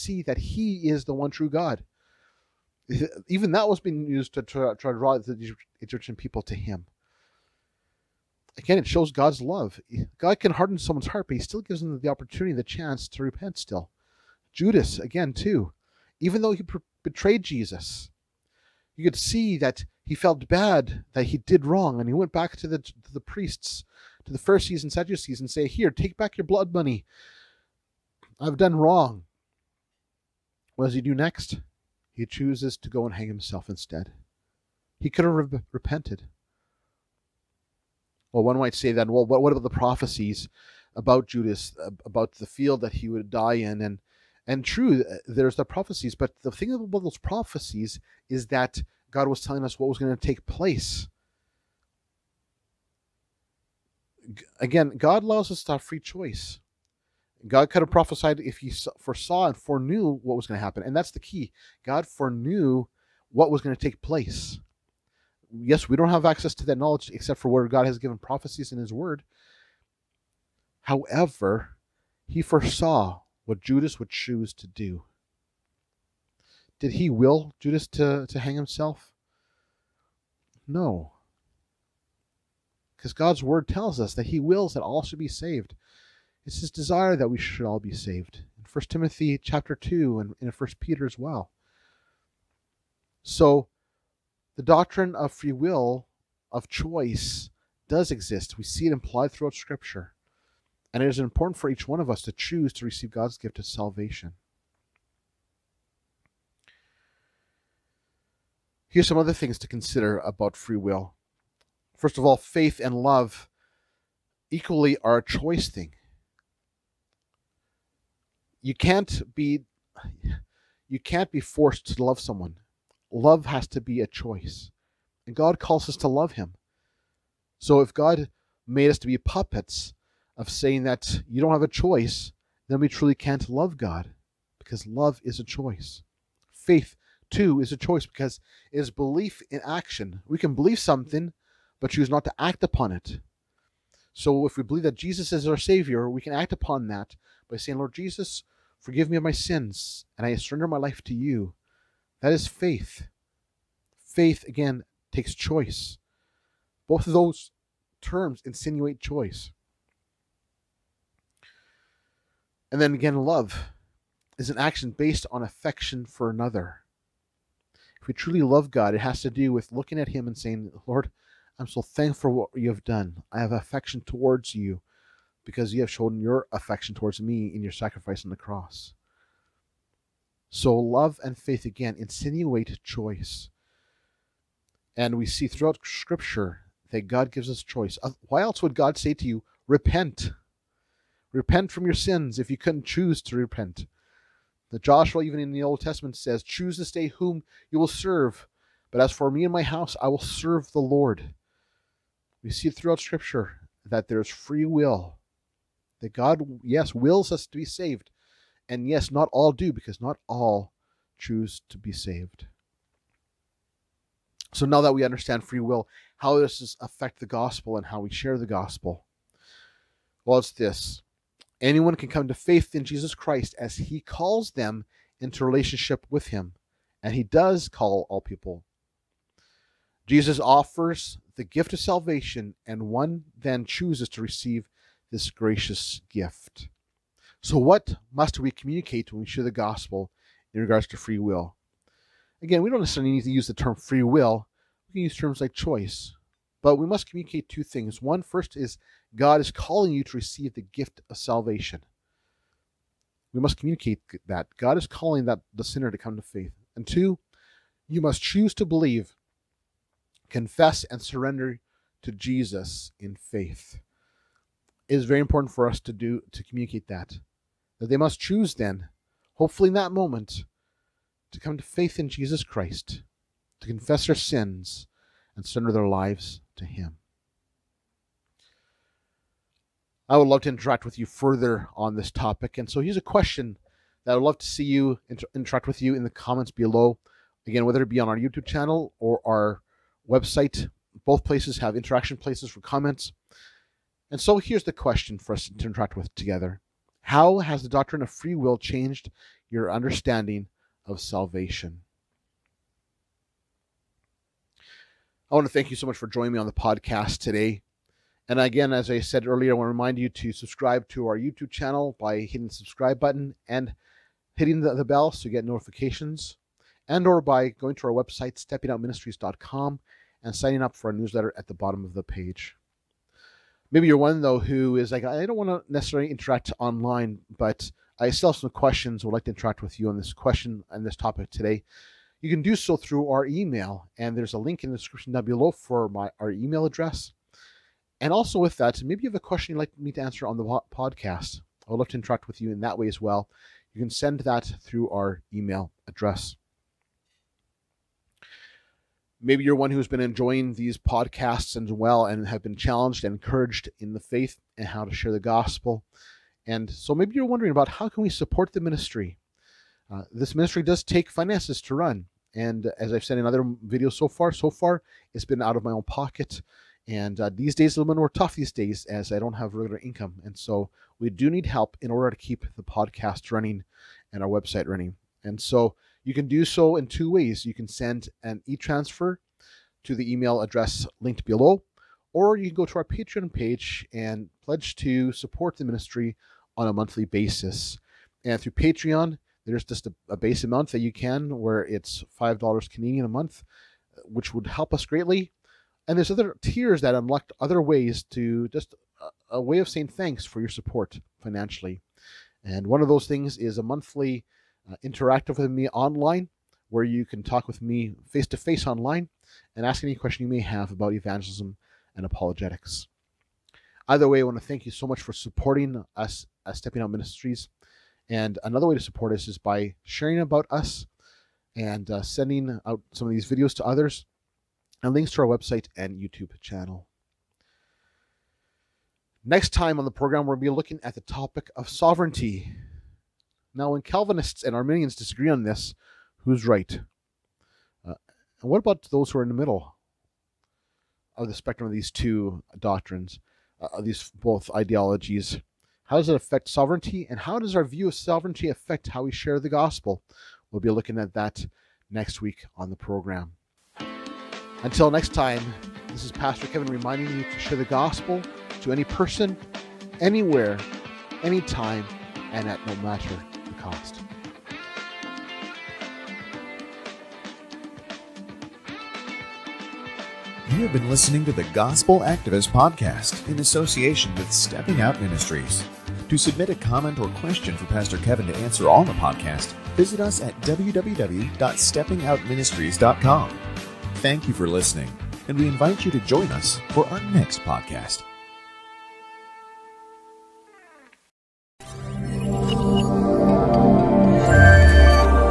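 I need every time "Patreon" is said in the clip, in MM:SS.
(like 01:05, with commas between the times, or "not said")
06:22, 06:28.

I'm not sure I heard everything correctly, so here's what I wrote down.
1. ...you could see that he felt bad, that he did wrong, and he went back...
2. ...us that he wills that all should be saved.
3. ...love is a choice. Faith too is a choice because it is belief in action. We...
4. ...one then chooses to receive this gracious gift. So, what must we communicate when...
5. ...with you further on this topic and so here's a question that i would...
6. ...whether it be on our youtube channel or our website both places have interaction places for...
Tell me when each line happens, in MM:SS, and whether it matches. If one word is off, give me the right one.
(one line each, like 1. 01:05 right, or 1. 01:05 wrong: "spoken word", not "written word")
1. 00:18 right
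2. 01:23 right
3. 02:14 right
4. 03:52 right
5. 04:40 right
6. 04:47 right.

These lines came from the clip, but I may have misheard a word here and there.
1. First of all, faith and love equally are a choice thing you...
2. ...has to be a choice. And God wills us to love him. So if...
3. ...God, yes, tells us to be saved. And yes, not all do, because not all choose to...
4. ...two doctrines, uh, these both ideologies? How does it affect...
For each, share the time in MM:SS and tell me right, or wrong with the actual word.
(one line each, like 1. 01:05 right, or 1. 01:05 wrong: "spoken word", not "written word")
1. 01:51 right
2. 02:03 wrong: "calls", not "wills"
3. 03:26 wrong: "wills", not "tells"
4. 07:21 right.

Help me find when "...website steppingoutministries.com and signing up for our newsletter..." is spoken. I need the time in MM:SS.
05:18.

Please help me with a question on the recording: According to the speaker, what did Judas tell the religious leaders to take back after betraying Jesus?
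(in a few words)
blood money.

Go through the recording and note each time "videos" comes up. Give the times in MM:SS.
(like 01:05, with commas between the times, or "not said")
06:03, 07:03.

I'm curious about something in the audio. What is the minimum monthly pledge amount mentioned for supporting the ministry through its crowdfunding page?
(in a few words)
$5 Canadian.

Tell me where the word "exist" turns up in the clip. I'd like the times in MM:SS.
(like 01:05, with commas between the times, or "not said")
01:38.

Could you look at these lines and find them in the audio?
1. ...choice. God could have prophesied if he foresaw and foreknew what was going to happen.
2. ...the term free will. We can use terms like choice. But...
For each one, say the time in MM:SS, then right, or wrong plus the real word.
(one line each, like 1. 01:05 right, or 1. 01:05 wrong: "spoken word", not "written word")
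1. 00:55 right
2. 04:03 right.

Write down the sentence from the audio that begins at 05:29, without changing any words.
Would like to interact with you on this question and this topic today.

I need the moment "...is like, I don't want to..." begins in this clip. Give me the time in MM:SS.
05:24.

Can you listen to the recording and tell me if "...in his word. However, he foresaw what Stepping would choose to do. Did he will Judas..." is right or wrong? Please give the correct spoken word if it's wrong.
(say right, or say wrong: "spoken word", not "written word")
wrong: "Judas", not "Stepping".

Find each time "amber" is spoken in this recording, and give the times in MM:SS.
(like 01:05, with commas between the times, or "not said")
not said.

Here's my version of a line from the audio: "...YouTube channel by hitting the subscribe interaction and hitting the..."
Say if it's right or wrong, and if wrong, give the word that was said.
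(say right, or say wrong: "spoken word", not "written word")
wrong: "button", not "interaction".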